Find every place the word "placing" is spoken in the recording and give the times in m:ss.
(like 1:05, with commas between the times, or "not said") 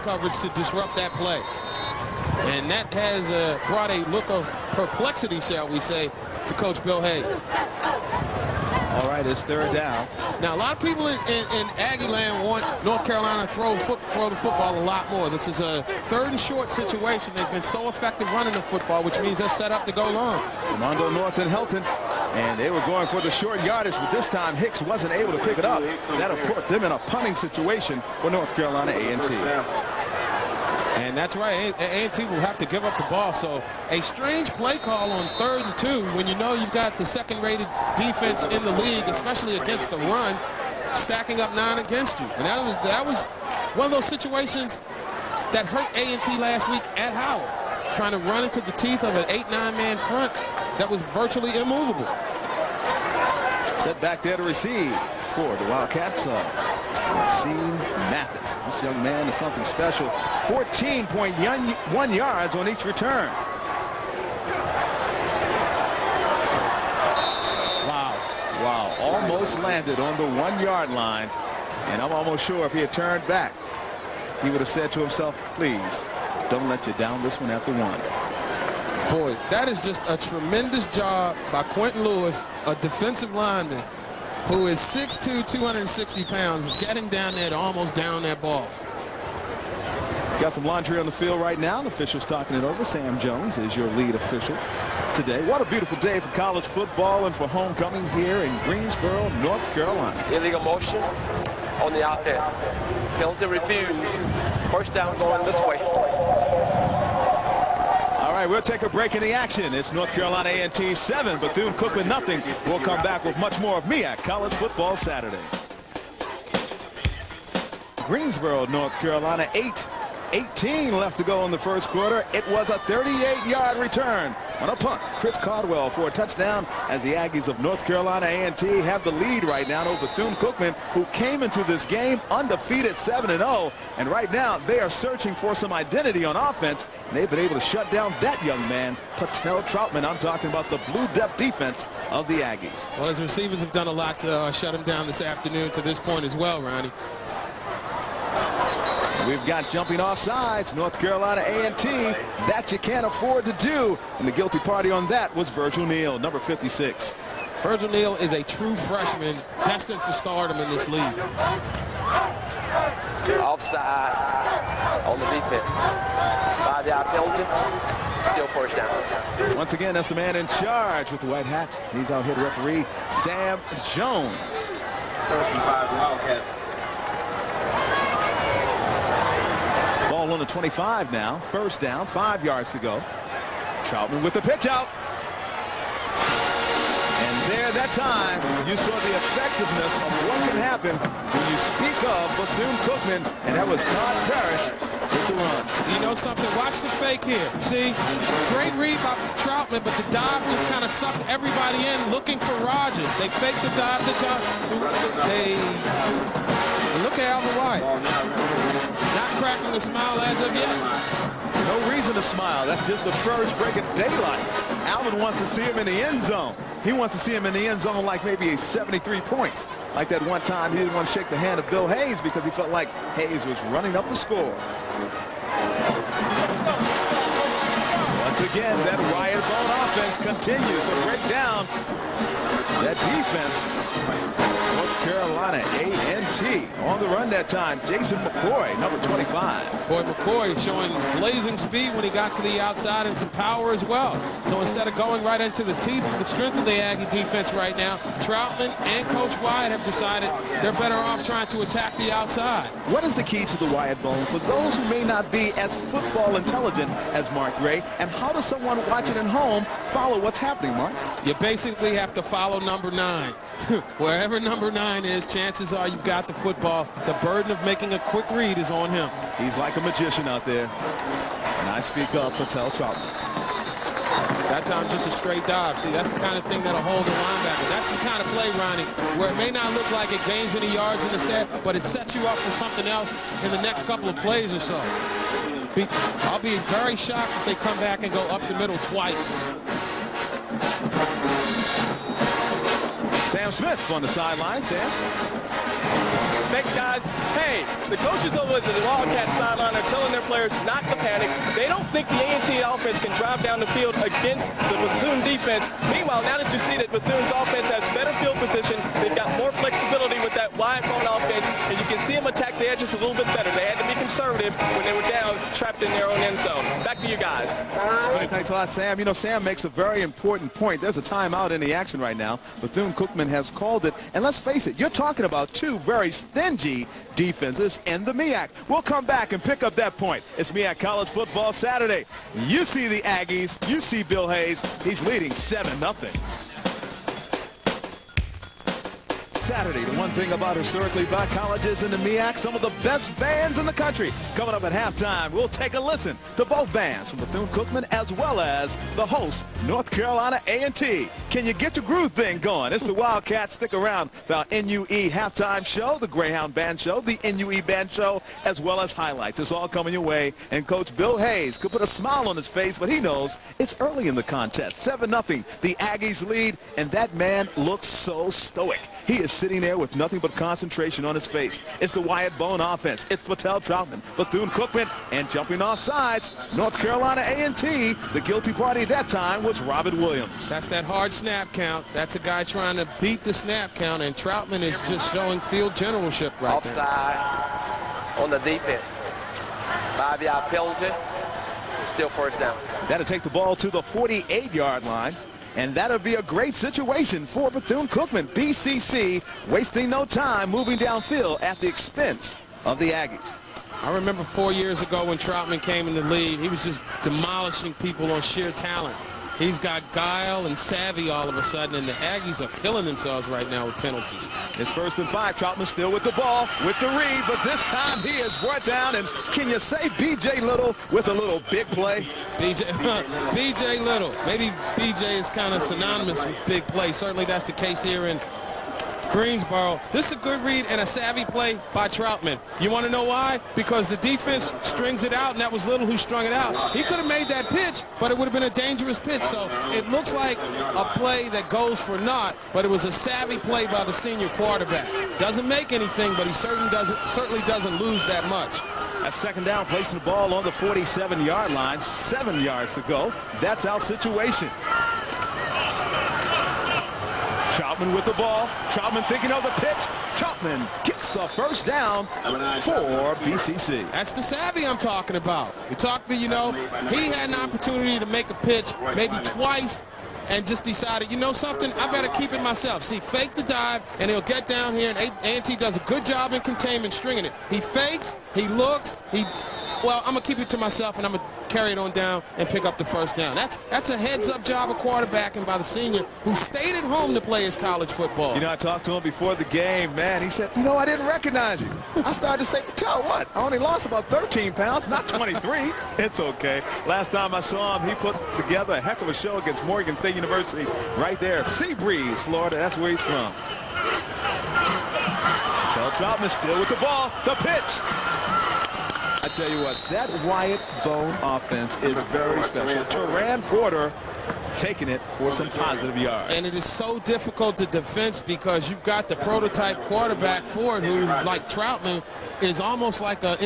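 7:29.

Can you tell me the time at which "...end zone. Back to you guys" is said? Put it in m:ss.
5:16.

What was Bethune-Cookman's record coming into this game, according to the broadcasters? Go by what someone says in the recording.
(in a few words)
7-0.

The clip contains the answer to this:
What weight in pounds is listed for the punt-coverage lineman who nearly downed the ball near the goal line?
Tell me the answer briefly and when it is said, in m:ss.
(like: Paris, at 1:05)
260, at 1:25.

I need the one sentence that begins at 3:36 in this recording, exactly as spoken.
He wants to see him in the end zone like maybe a 73 points.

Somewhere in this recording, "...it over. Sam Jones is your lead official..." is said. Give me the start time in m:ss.
1:32.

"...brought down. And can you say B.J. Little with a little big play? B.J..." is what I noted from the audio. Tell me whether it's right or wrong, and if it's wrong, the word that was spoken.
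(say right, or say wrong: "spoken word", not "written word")
right.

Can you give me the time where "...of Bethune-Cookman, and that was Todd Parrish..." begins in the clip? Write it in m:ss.
3:12.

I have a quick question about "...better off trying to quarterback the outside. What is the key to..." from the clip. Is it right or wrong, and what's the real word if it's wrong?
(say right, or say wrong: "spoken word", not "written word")
wrong: "attack", not "quarterback".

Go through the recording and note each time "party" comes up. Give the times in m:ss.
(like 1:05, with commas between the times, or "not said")
2:34, 6:18.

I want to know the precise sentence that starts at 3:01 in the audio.
First down, five yards to go.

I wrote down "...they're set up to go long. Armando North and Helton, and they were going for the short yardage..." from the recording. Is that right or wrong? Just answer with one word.
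right.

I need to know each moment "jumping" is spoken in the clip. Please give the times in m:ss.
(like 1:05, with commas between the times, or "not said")
2:29, 6:15.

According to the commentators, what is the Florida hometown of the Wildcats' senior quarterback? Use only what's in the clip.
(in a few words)
Sea Breeze.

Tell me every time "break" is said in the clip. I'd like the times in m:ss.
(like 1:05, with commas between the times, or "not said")
1:48, 3:33, 3:51.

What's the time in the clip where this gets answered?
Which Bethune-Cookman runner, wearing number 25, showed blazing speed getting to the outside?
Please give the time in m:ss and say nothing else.
3:57.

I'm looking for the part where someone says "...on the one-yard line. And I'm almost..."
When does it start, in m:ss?
1:09.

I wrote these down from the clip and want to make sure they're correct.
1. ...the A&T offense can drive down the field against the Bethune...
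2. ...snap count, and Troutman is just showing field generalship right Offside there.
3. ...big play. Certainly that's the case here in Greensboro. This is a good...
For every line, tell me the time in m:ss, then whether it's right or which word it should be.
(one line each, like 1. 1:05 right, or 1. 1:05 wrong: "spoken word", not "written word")
1. 5:02 right
2. 6:23 right
3. 7:06 right.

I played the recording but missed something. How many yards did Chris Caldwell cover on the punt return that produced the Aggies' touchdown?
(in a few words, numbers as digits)
38.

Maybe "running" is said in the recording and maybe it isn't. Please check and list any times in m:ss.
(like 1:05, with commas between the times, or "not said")
0:18, 3:43.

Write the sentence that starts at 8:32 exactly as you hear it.
Teran Porter taking it for some positive yards.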